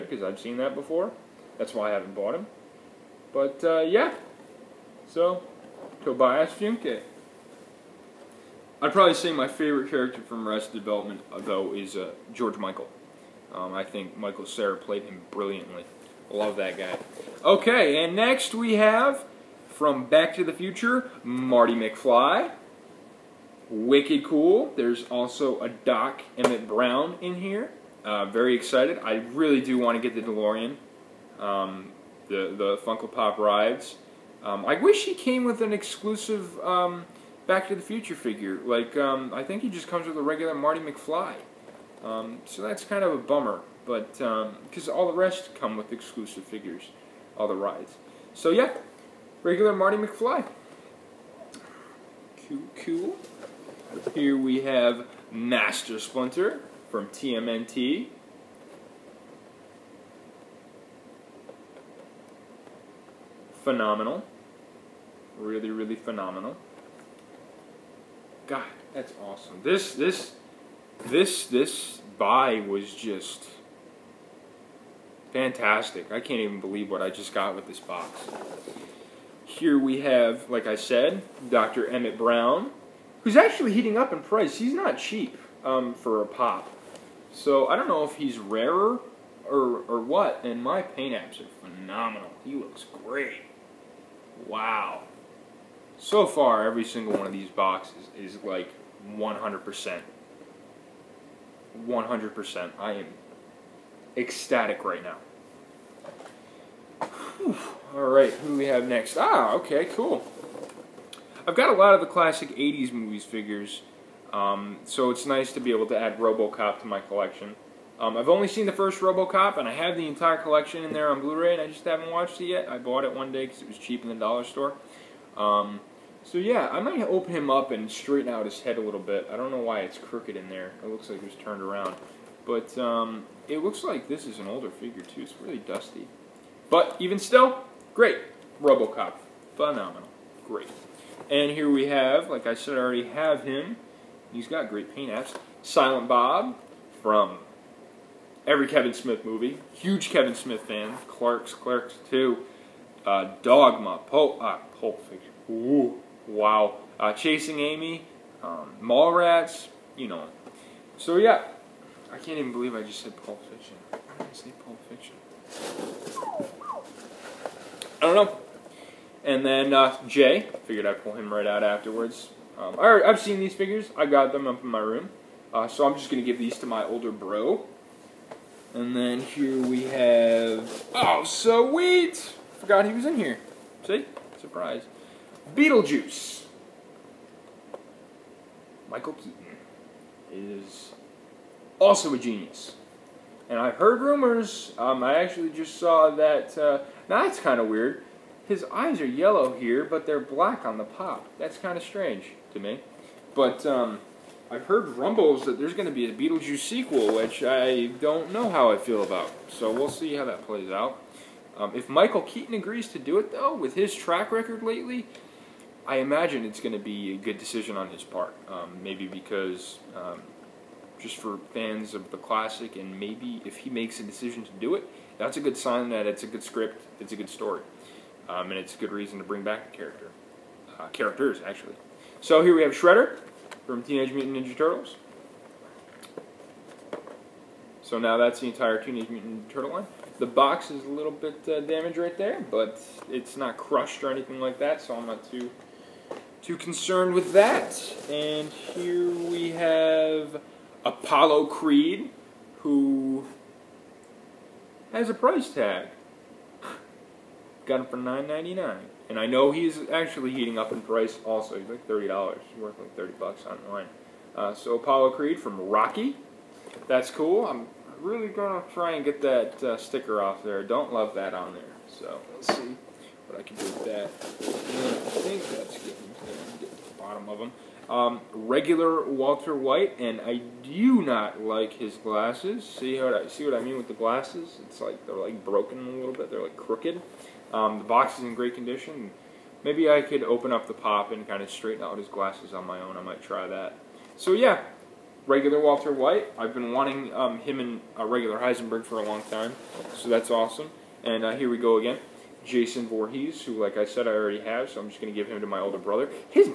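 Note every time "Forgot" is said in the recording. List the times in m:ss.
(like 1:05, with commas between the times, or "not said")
3:02.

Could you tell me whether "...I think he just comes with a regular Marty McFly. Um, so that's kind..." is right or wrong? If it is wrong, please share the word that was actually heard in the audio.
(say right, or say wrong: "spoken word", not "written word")
right.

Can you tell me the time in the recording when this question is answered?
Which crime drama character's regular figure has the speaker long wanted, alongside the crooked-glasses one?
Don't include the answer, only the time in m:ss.
4:58.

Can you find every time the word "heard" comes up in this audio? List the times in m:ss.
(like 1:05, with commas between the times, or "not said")
3:13, 3:24.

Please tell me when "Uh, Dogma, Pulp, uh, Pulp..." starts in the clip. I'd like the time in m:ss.
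2:33.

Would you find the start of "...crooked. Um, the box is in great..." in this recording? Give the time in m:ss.
4:46.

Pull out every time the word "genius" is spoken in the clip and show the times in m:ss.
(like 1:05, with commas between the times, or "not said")
3:12.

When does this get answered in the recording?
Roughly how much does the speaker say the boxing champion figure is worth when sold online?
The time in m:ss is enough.
4:22.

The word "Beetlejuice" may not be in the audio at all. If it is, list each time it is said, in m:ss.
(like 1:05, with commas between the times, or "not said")
3:05, 3:26.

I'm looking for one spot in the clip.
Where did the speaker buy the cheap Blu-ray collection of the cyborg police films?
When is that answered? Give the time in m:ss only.
2:04.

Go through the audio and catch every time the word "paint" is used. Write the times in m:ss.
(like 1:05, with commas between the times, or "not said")
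1:30, 2:24.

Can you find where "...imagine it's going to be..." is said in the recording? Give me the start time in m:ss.
3:35.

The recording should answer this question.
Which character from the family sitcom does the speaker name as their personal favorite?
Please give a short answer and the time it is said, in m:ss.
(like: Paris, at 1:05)
George Michael, at 0:12.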